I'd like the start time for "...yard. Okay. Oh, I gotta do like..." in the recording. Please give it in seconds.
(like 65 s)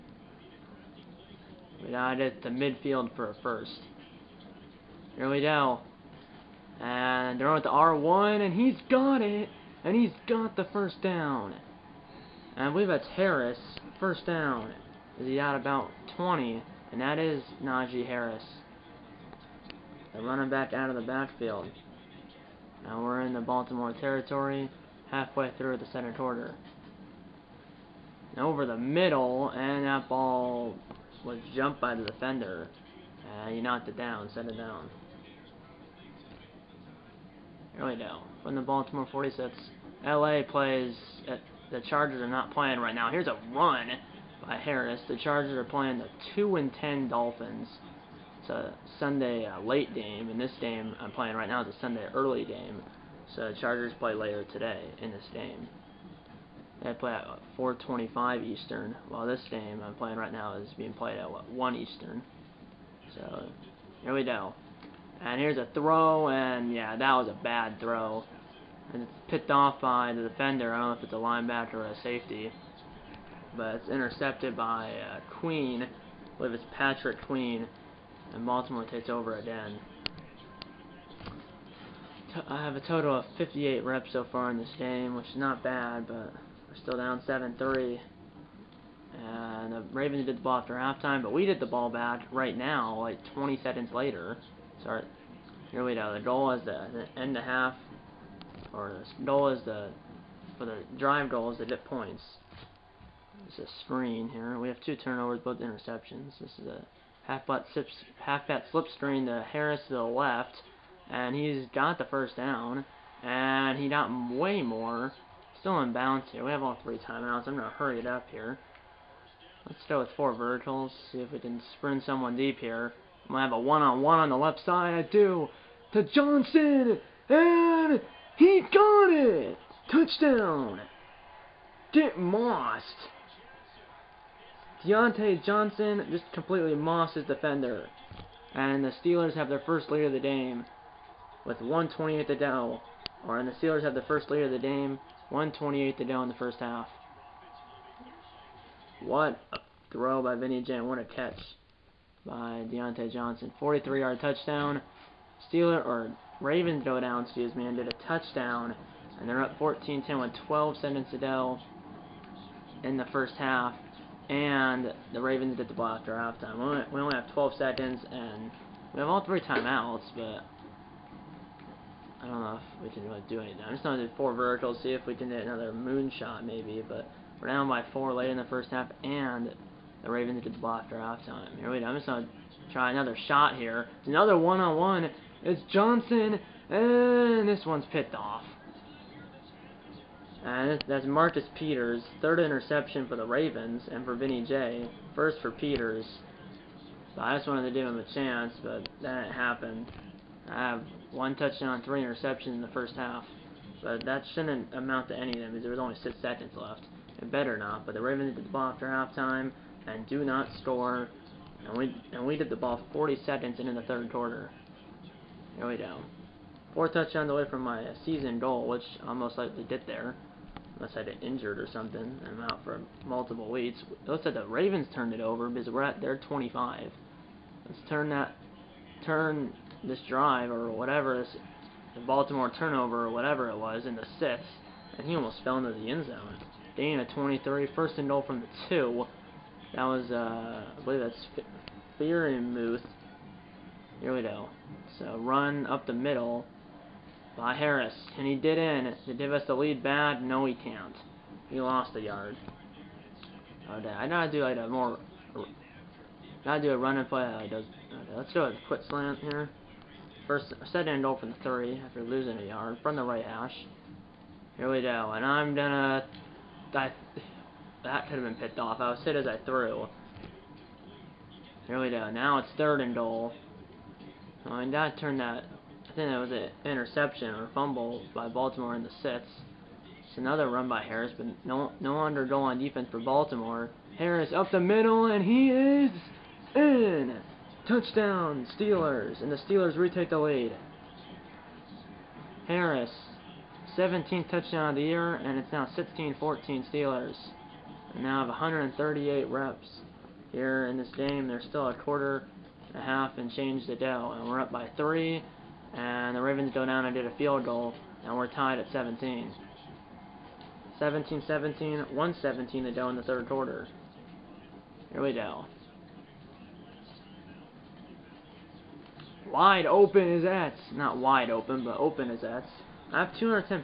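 252 s.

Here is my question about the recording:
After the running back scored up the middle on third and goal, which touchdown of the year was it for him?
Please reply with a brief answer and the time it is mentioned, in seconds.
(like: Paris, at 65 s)
17th, at 293 s.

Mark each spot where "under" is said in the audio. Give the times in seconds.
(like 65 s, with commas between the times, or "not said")
281 s.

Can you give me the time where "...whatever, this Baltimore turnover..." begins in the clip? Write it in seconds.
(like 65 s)
230 s.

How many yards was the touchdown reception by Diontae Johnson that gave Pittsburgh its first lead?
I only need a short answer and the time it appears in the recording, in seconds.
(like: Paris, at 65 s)
43, at 153 s.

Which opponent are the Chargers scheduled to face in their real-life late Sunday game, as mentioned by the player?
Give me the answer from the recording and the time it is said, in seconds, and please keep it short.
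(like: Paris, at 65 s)
Dolphins, at 47 s.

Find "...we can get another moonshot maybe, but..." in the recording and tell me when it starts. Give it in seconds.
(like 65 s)
175 s.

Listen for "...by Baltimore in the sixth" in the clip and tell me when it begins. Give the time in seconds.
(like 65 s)
278 s.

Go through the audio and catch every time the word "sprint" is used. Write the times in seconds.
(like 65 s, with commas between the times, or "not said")
121 s.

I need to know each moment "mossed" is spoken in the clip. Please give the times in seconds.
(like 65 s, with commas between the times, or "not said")
132 s, 136 s.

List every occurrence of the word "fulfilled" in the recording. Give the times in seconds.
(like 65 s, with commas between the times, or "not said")
not said.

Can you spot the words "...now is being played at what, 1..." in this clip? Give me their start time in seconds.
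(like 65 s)
60 s.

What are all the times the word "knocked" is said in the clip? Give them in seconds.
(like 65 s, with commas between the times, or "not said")
33 s.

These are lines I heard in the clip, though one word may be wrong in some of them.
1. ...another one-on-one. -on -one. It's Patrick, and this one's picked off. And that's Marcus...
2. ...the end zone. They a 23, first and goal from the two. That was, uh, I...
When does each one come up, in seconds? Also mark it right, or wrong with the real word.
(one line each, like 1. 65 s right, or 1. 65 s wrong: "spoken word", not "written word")
1. 184 s wrong: "Johnson", not "Patrick"
2. 235 s right.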